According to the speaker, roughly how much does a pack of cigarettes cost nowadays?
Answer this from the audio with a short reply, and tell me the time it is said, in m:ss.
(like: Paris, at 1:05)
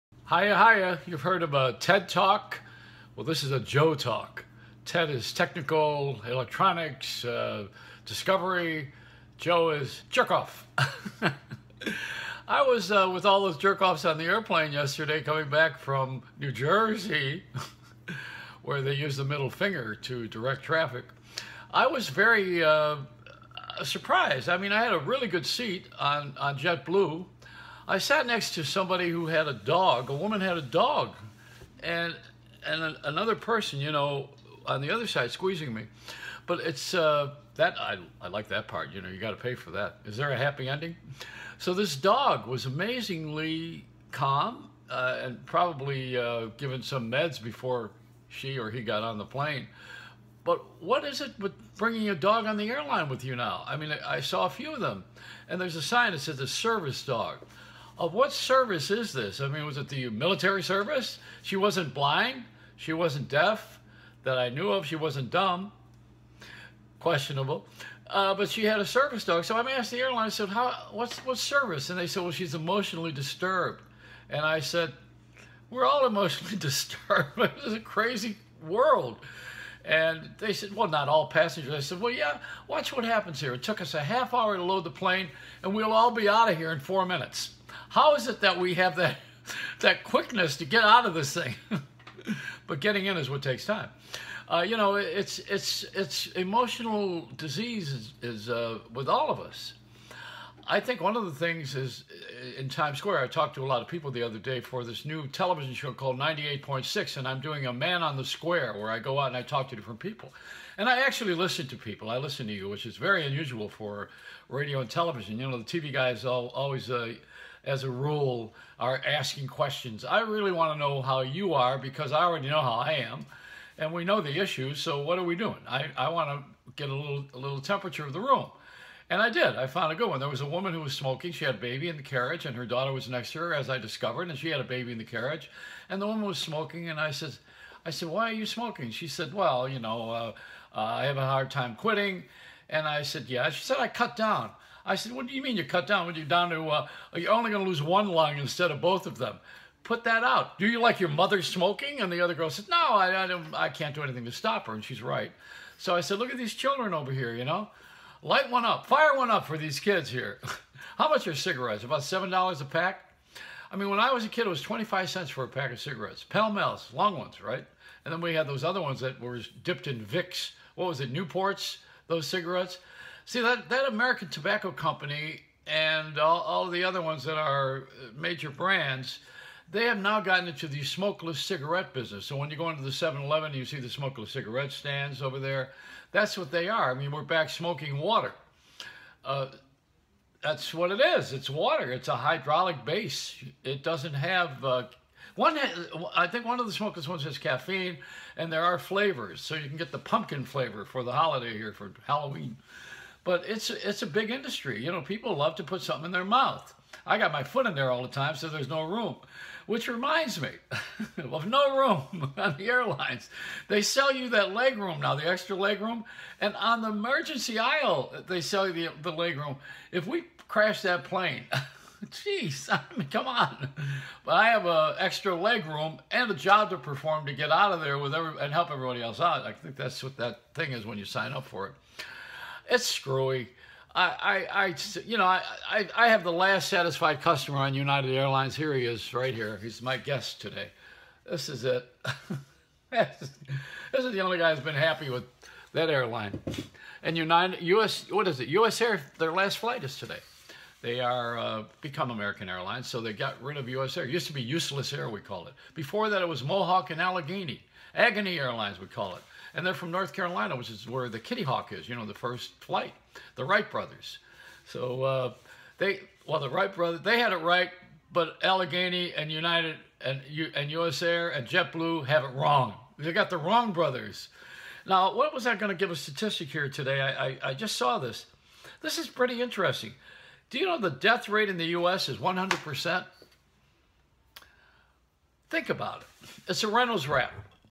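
$7, at 2:42.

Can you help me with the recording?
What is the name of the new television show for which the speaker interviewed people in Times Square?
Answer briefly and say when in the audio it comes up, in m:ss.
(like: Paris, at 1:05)
98.6, at 1:46.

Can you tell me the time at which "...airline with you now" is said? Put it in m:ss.
0:52.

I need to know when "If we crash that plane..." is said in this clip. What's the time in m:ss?
3:39.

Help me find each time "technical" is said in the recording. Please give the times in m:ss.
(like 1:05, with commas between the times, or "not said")
0:05.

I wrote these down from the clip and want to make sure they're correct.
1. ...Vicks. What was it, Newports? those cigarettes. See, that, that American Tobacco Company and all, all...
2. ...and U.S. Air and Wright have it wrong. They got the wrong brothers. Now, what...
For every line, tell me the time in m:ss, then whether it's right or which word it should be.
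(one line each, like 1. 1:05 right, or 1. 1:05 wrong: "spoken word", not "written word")
1. 2:50 right
2. 4:30 wrong: "JetBlue", not "Wright".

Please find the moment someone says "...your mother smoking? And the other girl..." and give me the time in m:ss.
2:30.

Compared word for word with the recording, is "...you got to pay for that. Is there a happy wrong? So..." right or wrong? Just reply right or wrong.
wrong.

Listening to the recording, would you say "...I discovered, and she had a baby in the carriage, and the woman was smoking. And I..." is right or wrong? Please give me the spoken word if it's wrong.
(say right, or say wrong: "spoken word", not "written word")
right.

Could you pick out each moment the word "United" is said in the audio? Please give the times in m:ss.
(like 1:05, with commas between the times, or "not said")
3:57, 4:07, 4:29.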